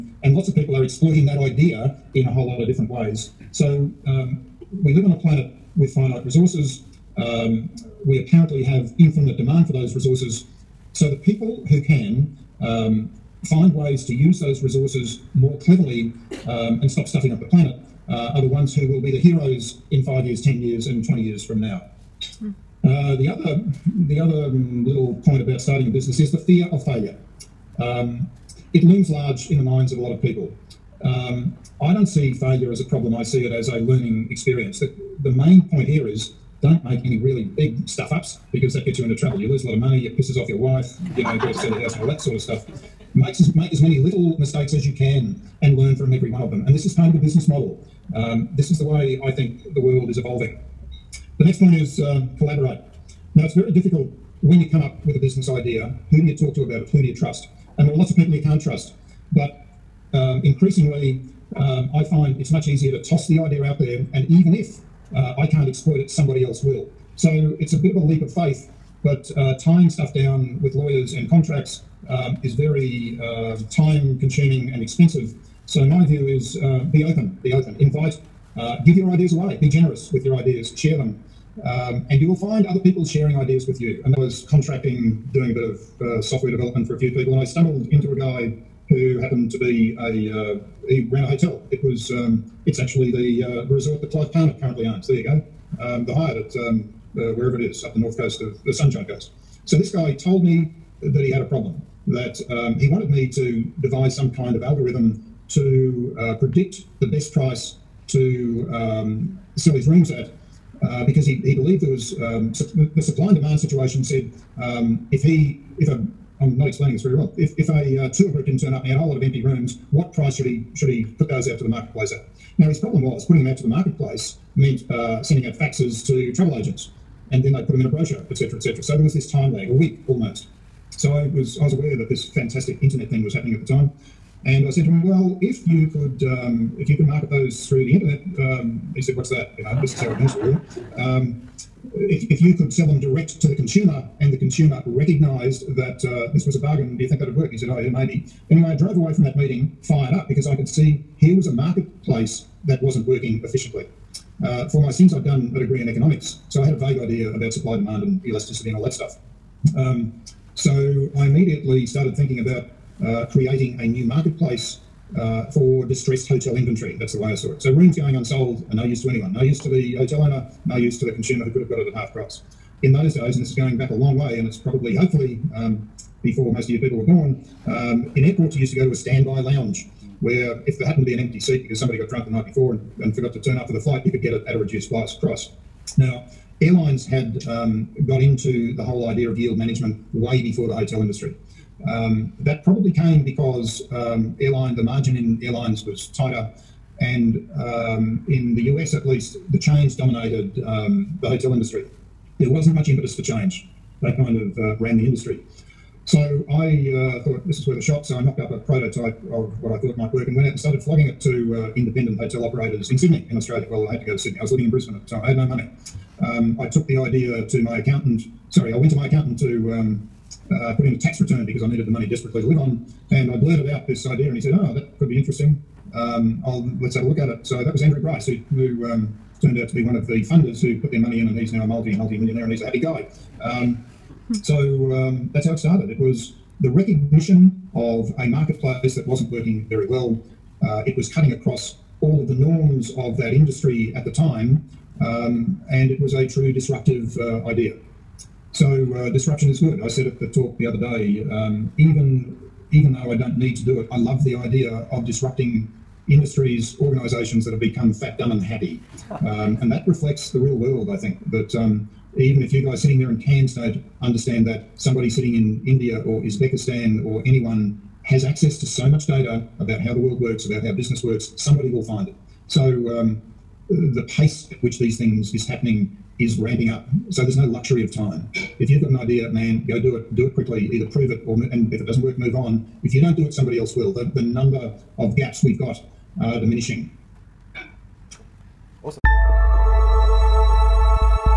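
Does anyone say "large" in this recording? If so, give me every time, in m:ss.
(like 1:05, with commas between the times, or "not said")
0:29.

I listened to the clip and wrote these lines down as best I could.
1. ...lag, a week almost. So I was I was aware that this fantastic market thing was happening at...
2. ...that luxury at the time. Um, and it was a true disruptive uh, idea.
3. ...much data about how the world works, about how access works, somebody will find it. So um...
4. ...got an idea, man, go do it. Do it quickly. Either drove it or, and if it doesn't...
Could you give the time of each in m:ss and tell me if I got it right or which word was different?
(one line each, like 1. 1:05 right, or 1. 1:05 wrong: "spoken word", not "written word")
1. 2:09 wrong: "internet", not "market"
2. 4:03 wrong: "industry", not "luxury"
3. 4:28 wrong: "business", not "access"
4. 4:38 wrong: "prove", not "drove".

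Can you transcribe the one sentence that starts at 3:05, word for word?
Now, Airlines had um, got into the whole idea of yield management way before the hotel industry.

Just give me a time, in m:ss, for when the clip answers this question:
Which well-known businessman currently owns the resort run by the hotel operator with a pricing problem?
1:34.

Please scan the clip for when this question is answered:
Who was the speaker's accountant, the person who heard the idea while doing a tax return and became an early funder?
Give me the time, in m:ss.
3:47.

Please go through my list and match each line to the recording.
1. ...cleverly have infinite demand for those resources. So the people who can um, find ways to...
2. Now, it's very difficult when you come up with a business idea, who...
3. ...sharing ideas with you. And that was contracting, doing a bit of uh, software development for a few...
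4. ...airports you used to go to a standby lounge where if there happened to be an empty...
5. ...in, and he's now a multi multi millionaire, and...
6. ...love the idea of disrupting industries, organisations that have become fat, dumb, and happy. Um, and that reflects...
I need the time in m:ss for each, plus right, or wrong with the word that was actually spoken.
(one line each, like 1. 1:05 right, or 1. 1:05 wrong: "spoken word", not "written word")
1. 0:08 wrong: "apparently", not "cleverly"
2. 0:53 right
3. 1:23 right
4. 2:58 right
5. 3:51 right
6. 4:13 right.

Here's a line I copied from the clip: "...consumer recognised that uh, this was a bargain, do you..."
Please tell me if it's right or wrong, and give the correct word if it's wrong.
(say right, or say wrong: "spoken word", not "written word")
right.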